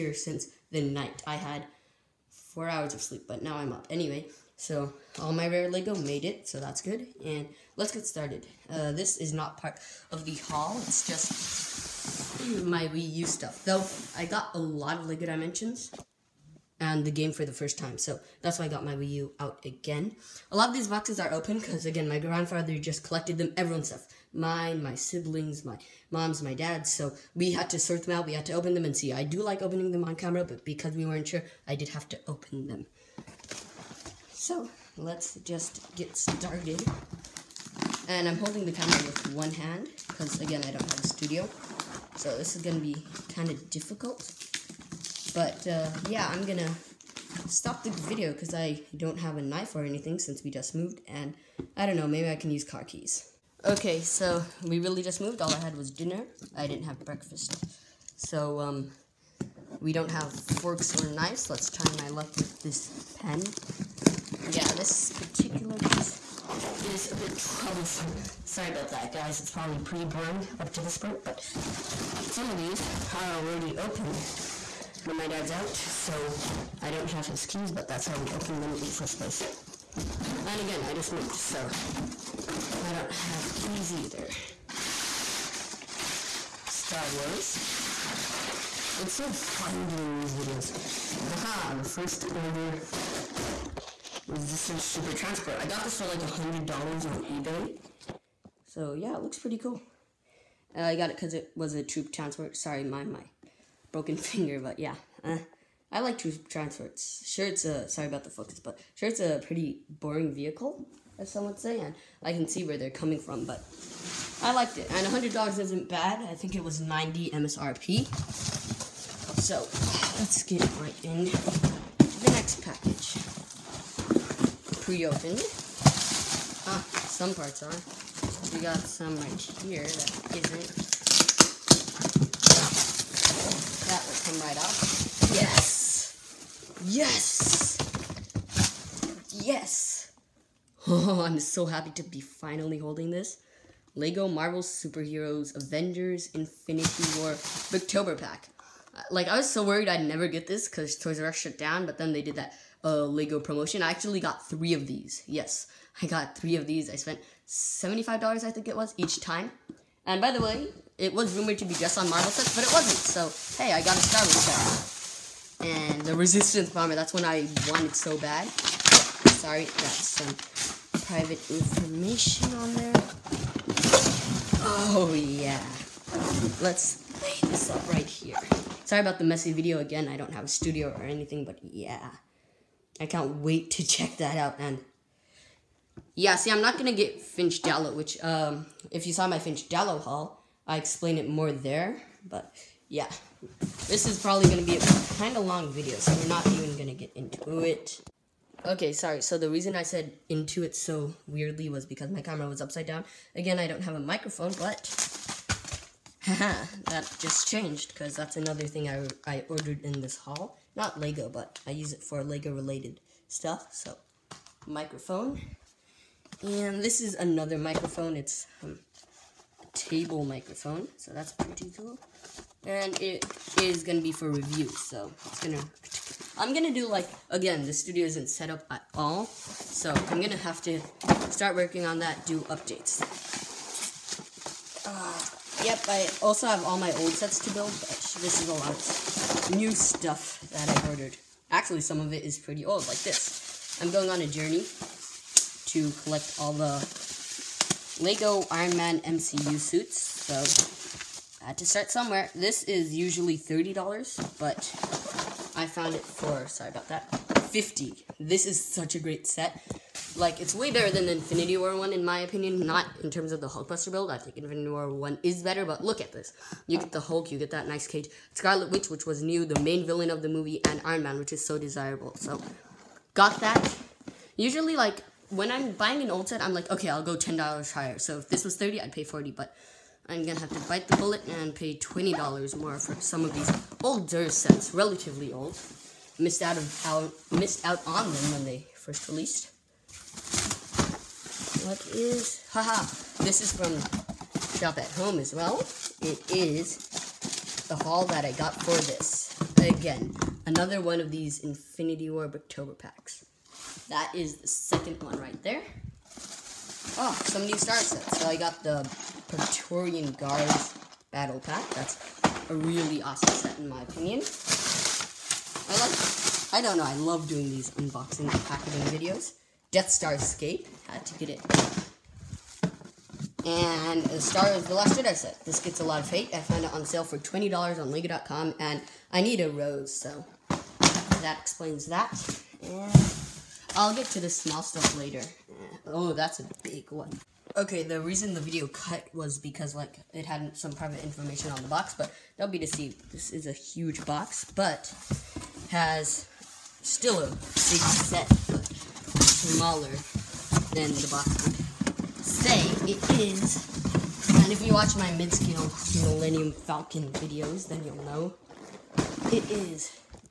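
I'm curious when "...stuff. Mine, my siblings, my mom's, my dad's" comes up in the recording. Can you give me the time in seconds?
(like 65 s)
23 s.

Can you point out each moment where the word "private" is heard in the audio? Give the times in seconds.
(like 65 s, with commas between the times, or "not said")
171 s, 340 s.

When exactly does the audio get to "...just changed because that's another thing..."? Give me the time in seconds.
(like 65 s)
207 s.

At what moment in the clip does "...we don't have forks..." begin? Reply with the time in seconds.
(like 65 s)
59 s.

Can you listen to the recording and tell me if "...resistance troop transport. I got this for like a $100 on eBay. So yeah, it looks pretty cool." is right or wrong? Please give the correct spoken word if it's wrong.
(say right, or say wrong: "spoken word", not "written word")
right.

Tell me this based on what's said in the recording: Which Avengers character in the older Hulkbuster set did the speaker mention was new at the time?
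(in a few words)
Scarlet Witch.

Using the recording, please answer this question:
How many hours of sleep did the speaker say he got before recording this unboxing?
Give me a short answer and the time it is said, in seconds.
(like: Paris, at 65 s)
4, at 2 s.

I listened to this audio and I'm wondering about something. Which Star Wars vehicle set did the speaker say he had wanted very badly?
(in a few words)
Resistance Bomber.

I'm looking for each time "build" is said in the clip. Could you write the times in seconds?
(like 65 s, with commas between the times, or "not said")
237 s, 263 s.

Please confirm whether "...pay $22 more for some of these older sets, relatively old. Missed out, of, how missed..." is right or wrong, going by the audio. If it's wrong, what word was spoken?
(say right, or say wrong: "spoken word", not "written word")
wrong: "20", not "22".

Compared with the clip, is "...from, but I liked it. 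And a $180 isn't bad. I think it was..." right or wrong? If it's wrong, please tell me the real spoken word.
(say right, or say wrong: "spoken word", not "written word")
wrong: "100", not "180".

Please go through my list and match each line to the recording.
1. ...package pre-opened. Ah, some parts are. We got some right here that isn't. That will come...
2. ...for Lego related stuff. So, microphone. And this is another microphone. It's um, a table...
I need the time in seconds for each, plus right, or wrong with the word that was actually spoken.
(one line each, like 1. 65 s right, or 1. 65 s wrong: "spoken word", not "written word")
1. 122 s right
2. 212 s right.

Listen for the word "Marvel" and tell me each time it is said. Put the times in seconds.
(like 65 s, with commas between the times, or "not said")
144 s, 162 s.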